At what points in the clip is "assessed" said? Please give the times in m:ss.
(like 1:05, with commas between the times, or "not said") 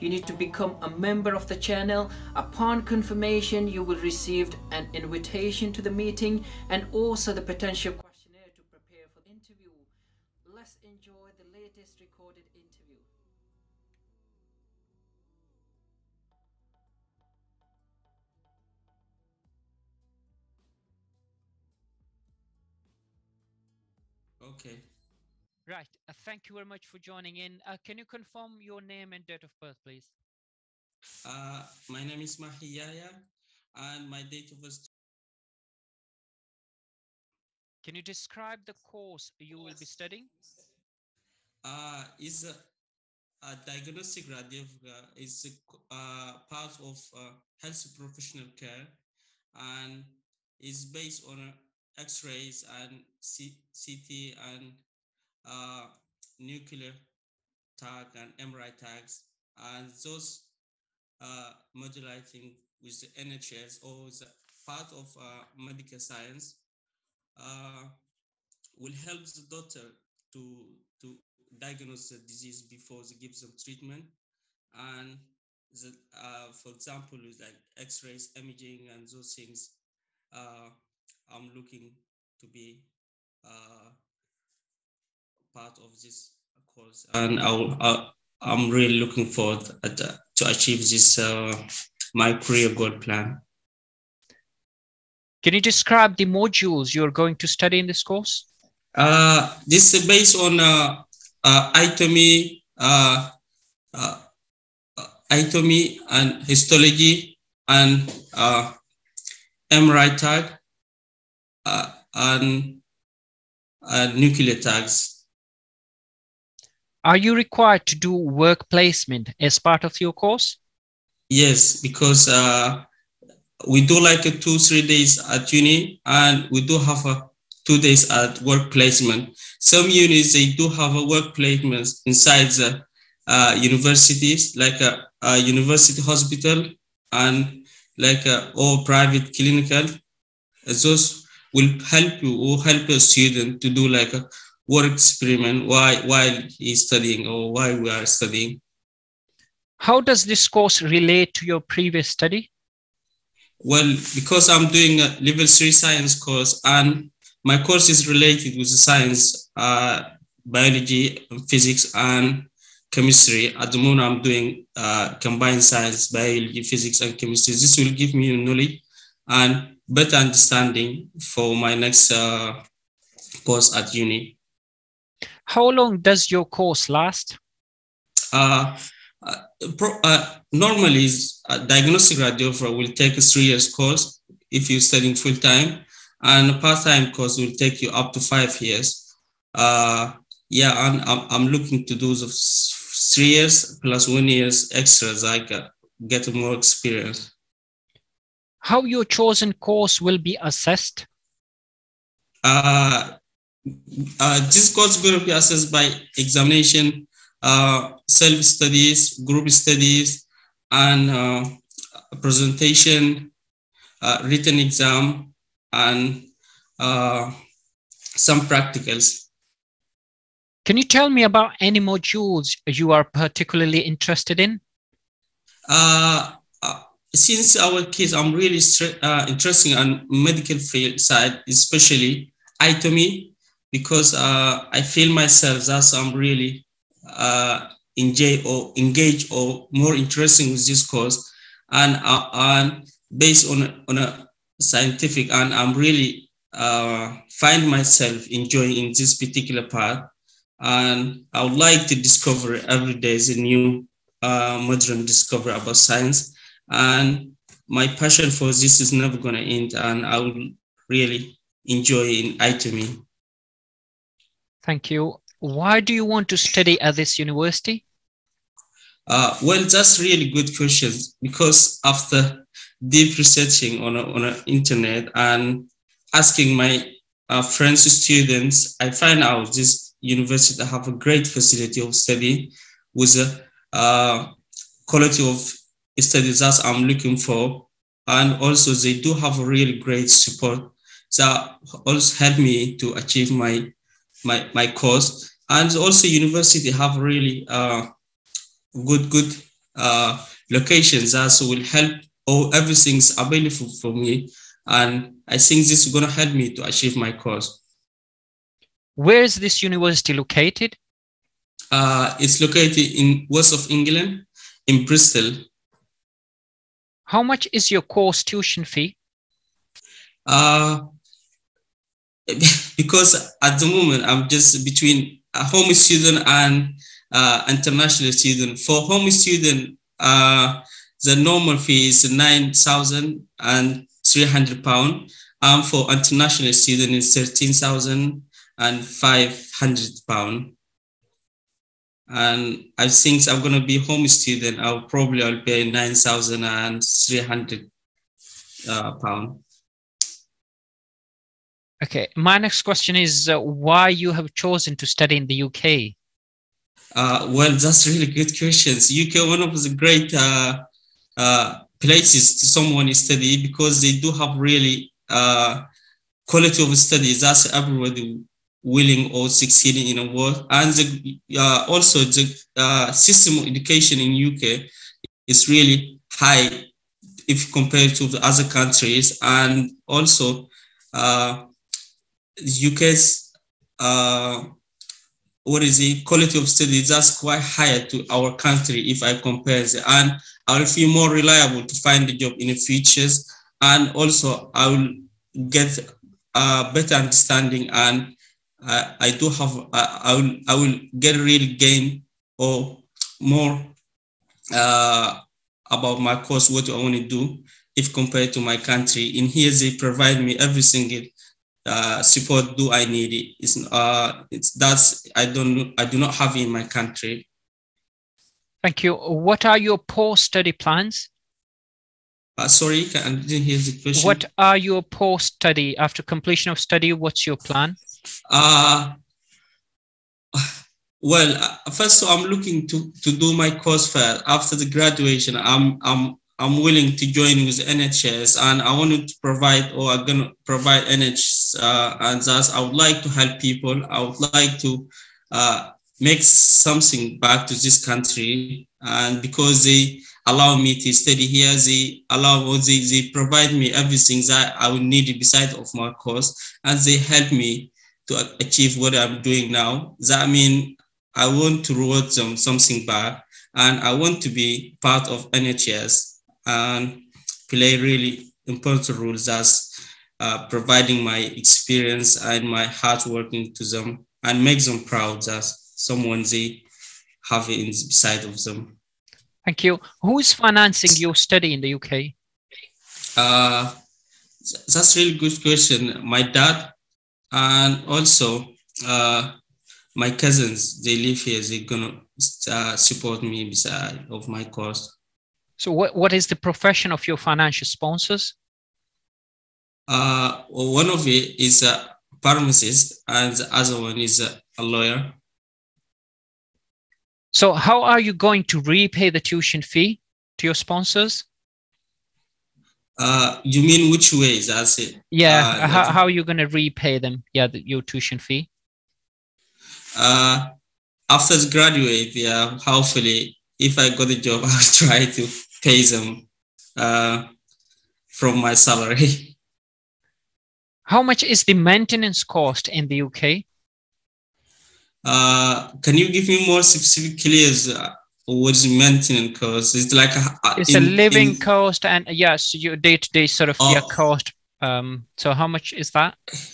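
3:20, 3:25.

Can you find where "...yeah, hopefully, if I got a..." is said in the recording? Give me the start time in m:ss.
8:42.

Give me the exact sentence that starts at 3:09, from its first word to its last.
Uh, yeah, I'm, I'm looking to do the three years plus one years extra so I can get more experience.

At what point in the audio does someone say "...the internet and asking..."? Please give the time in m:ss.
4:34.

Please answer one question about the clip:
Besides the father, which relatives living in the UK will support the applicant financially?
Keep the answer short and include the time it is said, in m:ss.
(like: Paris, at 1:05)
Cousins, at 8:10.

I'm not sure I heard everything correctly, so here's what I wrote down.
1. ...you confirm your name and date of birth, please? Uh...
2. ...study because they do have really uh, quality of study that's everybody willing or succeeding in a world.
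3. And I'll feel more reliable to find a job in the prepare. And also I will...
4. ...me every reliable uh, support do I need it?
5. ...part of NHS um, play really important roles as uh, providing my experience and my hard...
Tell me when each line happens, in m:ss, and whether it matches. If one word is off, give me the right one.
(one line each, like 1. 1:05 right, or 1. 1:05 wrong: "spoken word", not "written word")
1. 0:27 right
2. 6:02 right
3. 6:29 wrong: "future", not "prepare"
4. 6:50 wrong: "single", not "reliable"
5. 7:44 right.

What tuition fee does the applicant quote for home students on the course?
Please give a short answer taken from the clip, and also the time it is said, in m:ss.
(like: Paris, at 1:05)
£9,300, at 5:32.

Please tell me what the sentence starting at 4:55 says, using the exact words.
And also university have really uh, good, good uh, locations that uh, so will help all everything's available for me.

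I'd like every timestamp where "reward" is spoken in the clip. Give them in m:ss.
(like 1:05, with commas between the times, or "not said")
7:41.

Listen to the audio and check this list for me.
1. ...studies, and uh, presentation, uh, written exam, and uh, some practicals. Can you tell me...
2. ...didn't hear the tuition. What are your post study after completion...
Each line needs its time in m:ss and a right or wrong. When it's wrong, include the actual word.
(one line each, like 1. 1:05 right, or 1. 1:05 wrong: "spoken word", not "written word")
1. 3:29 right
2. 7:03 wrong: "question", not "tuition".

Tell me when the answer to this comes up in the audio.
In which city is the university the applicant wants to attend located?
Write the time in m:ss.
5:14.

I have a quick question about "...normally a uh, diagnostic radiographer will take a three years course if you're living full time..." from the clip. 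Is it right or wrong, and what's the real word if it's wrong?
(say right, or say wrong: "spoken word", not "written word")
wrong: "studying", not "living".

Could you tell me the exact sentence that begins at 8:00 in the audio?
Who's financing your study in the UK?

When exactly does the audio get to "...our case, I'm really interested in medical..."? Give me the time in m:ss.
3:47.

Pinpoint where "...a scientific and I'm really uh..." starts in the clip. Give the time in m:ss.
4:03.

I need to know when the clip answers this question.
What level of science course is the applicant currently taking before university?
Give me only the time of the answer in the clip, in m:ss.
2:35.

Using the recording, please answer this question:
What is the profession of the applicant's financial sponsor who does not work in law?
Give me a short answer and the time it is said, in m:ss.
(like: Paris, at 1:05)
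Pharmacist, at 8:22.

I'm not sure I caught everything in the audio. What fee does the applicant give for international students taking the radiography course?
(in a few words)
£13,500.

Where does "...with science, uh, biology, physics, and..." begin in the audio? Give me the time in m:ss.
2:38.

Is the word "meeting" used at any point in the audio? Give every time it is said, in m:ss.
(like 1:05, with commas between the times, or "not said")
0:05.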